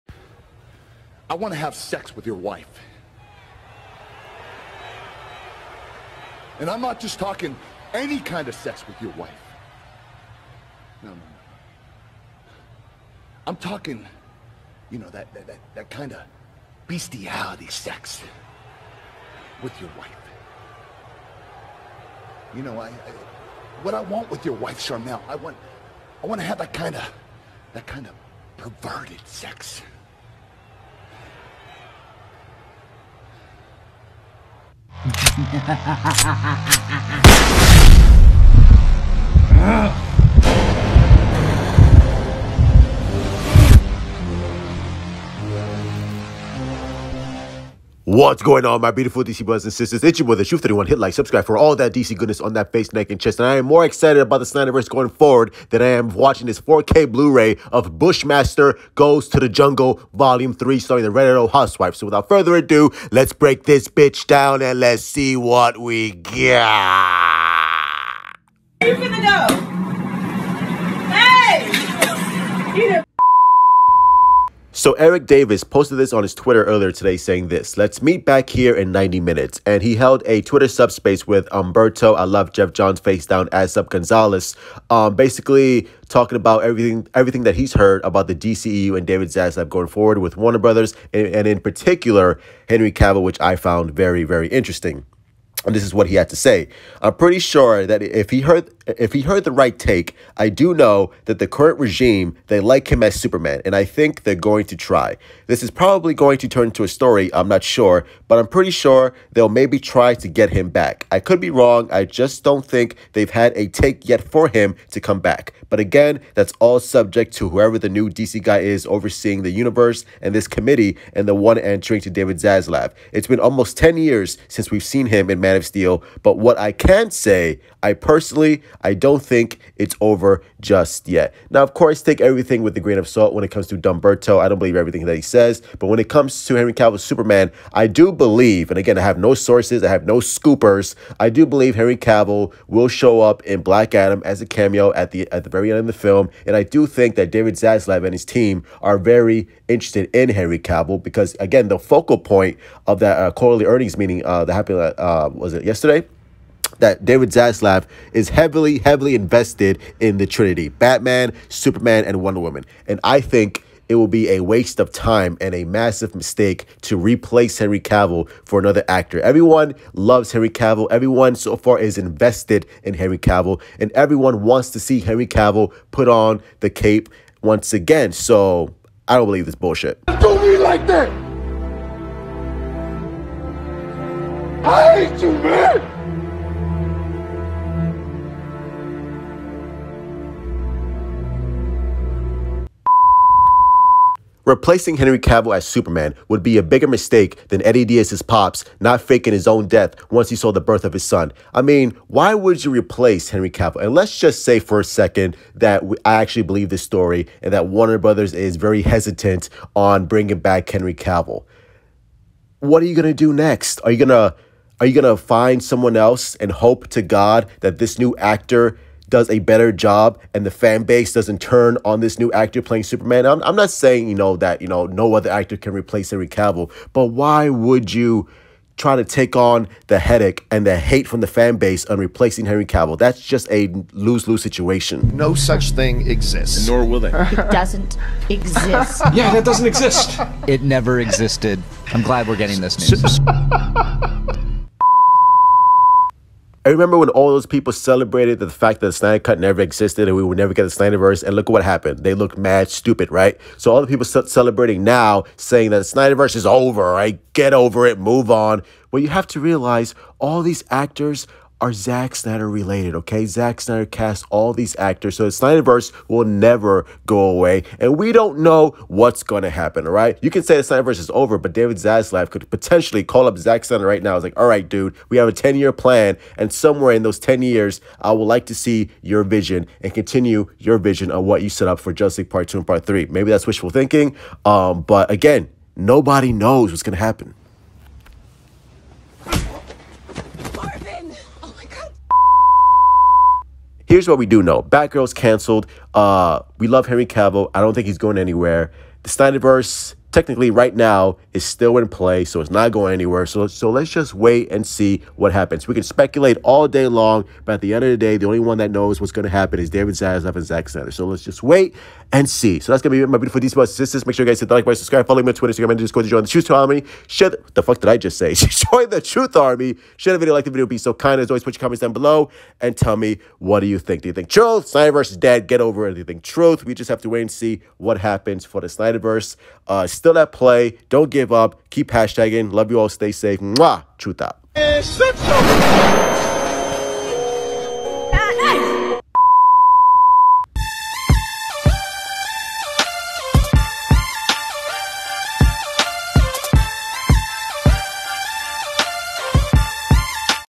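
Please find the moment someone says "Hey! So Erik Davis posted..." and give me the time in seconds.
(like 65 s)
72 s.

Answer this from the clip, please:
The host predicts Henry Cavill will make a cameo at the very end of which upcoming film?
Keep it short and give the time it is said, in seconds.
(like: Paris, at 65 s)
Black Adam, at 143 s.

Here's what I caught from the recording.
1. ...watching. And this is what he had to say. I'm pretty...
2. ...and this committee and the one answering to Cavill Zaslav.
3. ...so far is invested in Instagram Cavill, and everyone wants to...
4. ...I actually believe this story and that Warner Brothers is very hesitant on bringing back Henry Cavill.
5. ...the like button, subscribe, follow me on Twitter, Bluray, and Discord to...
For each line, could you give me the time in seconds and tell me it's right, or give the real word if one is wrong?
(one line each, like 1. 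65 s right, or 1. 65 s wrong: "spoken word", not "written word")
1. 94 s wrong: "interesting", not "watching"
2. 120 s wrong: "David", not "Cavill"
3. 171 s wrong: "Henry", not "Instagram"
4. 206 s right
5. 314 s wrong: "Instagram", not "Bluray".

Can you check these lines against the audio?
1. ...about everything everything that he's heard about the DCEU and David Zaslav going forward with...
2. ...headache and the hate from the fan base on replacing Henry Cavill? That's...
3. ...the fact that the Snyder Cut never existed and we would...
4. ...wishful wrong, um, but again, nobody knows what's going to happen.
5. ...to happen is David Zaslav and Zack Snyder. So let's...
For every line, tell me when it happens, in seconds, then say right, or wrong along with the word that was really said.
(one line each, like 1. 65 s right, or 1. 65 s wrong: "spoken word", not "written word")
1. 86 s right
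2. 229 s right
3. 248 s right
4. 283 s wrong: "thinking", not "wrong"
5. 309 s right.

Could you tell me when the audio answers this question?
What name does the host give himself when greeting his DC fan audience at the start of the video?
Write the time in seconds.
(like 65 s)
50 s.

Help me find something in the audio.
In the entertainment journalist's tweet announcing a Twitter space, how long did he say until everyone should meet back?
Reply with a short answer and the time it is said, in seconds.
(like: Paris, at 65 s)
90 minutes, at 78 s.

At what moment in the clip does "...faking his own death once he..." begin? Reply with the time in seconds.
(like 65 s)
198 s.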